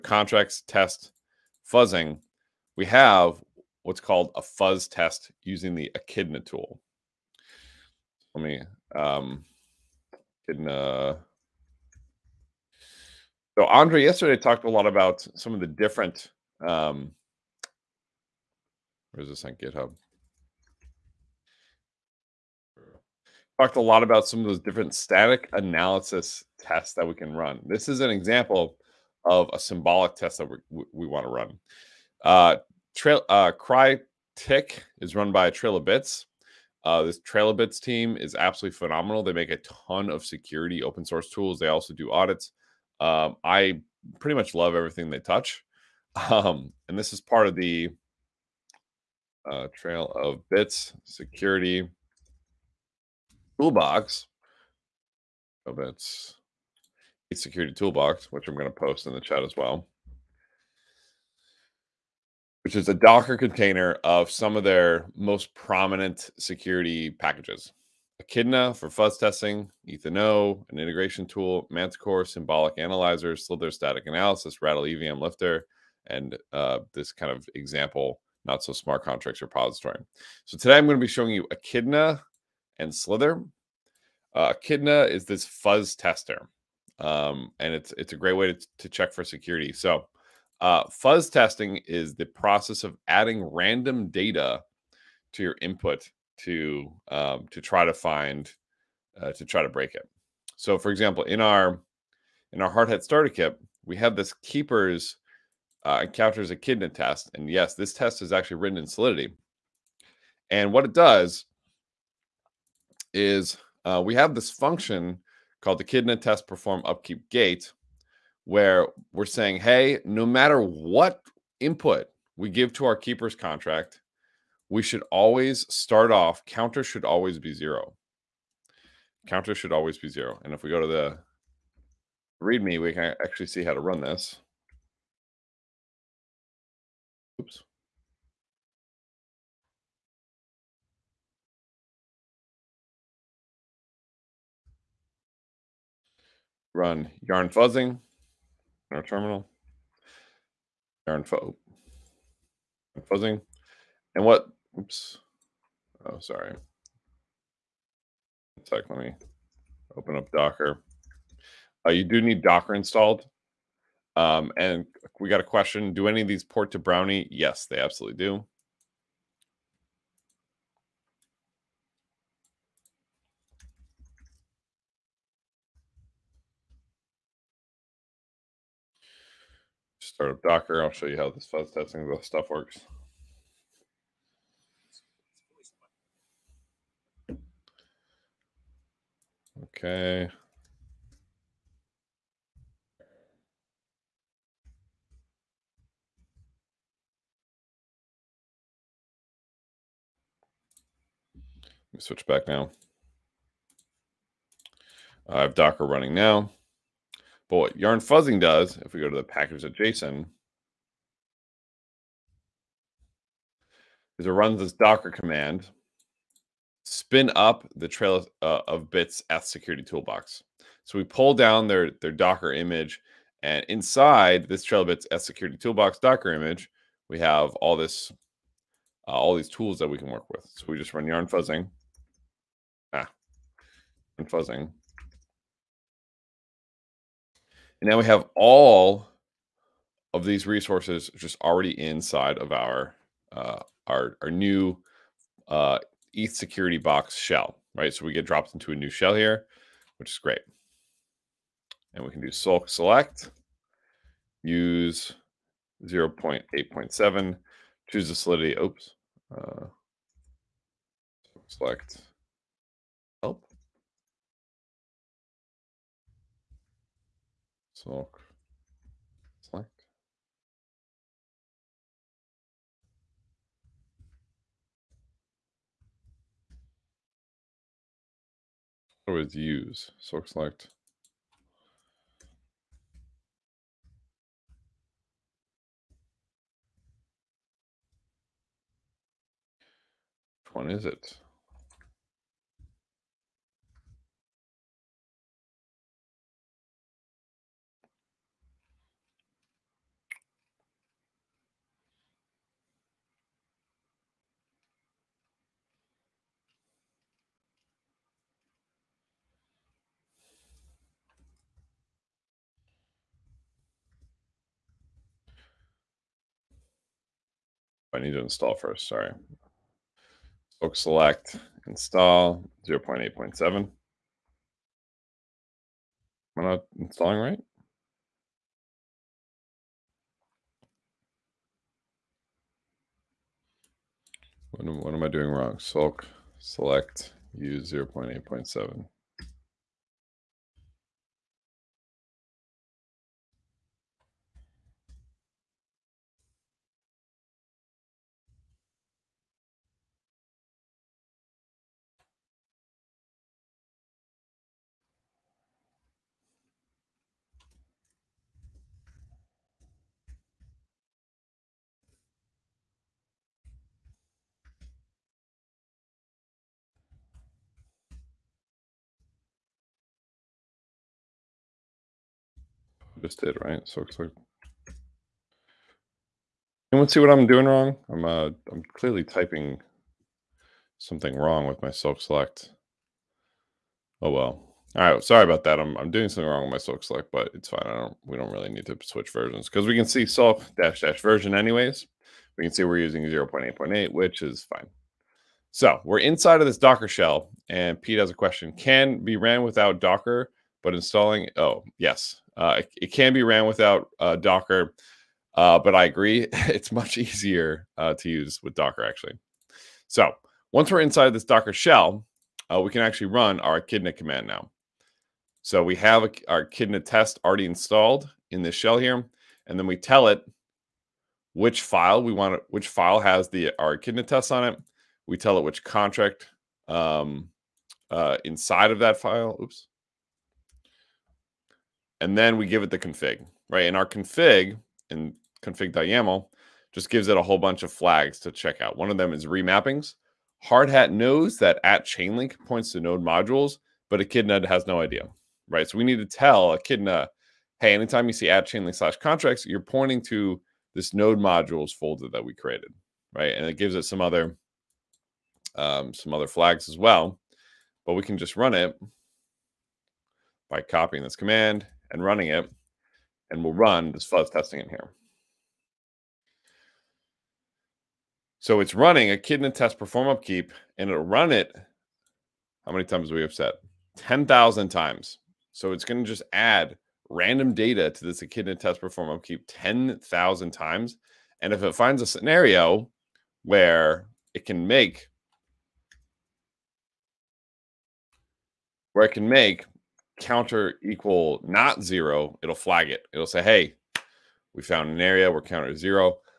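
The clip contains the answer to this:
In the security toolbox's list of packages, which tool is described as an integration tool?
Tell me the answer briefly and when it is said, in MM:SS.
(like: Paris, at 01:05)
Etheno, at 01:09.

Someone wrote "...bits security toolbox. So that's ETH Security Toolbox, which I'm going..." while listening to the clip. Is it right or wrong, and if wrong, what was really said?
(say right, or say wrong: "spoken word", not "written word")
right.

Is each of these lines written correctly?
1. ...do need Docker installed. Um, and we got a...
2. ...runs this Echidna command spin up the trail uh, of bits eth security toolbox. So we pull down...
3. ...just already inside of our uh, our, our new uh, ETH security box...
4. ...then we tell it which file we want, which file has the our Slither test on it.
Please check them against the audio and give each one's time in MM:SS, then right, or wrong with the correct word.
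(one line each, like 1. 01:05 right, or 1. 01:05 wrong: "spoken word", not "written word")
1. 02:42 right
2. 03:34 wrong: "Docker", not "Echidna"
3. 04:01 right
4. 06:59 wrong: "Echidna", not "Slither".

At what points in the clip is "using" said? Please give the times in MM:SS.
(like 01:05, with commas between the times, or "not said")
00:05, 06:32.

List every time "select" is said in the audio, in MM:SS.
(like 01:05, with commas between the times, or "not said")
04:12, 04:21, 04:40, 05:20, 05:36, 06:22, 06:26.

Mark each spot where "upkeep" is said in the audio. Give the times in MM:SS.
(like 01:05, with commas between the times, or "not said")
01:56, 07:50, 07:59.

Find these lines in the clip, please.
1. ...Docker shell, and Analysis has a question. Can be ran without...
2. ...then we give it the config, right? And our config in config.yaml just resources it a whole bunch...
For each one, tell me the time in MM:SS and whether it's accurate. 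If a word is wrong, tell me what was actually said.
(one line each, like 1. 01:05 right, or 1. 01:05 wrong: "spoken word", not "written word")
1. 06:36 wrong: "Pete", not "Analysis"
2. 07:12 wrong: "gives", not "resources".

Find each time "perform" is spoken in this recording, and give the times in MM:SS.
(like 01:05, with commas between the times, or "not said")
01:56, 07:49, 07:58.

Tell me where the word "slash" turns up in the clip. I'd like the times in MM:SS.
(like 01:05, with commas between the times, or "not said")
07:28.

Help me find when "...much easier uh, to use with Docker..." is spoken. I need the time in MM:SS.
06:46.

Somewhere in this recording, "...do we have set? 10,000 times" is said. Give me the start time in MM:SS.
07:53.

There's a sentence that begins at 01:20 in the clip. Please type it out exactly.
So today I'm going to be showing you Echidna and Slither.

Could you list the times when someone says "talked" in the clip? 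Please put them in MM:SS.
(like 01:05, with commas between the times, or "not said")
00:14, 00:23.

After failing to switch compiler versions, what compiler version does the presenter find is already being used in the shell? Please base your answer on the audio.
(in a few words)
0.8.8.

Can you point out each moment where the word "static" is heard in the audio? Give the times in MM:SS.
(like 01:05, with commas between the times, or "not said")
00:24, 01:13.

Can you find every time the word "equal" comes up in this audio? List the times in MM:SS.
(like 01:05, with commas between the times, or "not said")
08:10.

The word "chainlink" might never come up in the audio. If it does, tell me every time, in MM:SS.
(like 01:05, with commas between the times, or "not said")
07:21, 07:28.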